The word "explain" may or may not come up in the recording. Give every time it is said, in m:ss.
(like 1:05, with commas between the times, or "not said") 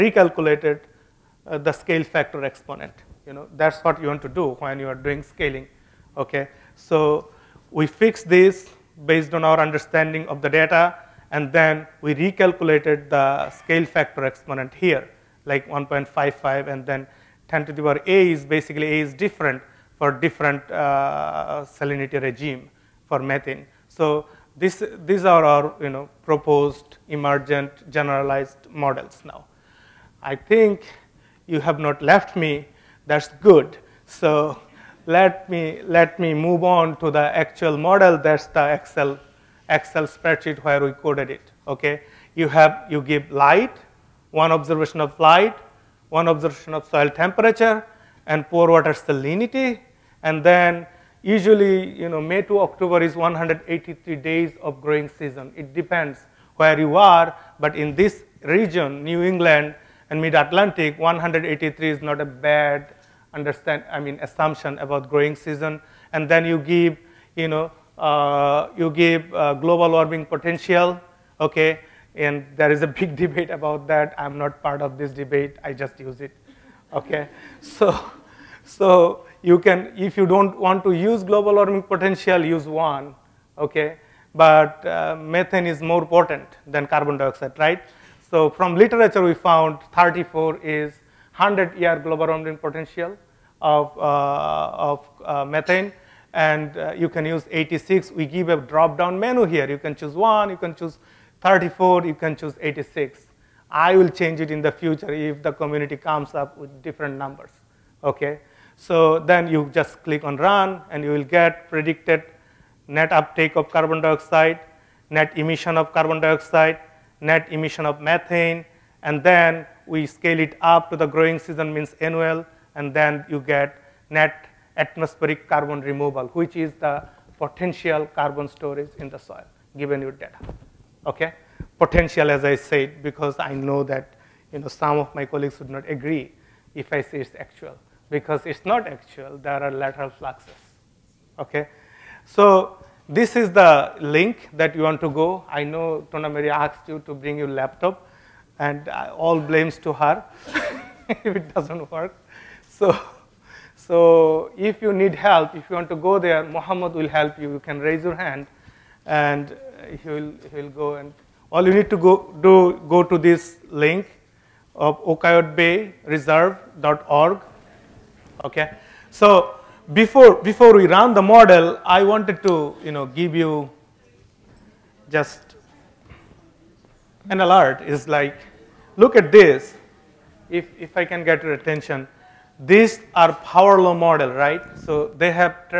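not said.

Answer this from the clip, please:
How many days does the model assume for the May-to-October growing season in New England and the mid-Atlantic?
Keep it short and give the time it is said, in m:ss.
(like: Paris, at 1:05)
183, at 0:53.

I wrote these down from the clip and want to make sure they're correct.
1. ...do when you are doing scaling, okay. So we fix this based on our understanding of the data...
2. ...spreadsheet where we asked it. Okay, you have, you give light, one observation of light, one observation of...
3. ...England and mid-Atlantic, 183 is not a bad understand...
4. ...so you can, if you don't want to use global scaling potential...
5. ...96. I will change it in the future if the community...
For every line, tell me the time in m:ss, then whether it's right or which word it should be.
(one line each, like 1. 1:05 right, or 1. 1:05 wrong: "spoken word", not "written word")
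1. 0:04 right
2. 0:40 wrong: "coded", not "asked"
3. 0:59 right
4. 1:18 wrong: "warming", not "scaling"
5. 1:42 wrong: "86", not "96".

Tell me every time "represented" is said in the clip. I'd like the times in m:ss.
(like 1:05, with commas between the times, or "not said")
not said.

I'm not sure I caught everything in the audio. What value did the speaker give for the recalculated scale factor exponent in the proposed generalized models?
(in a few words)
1.55.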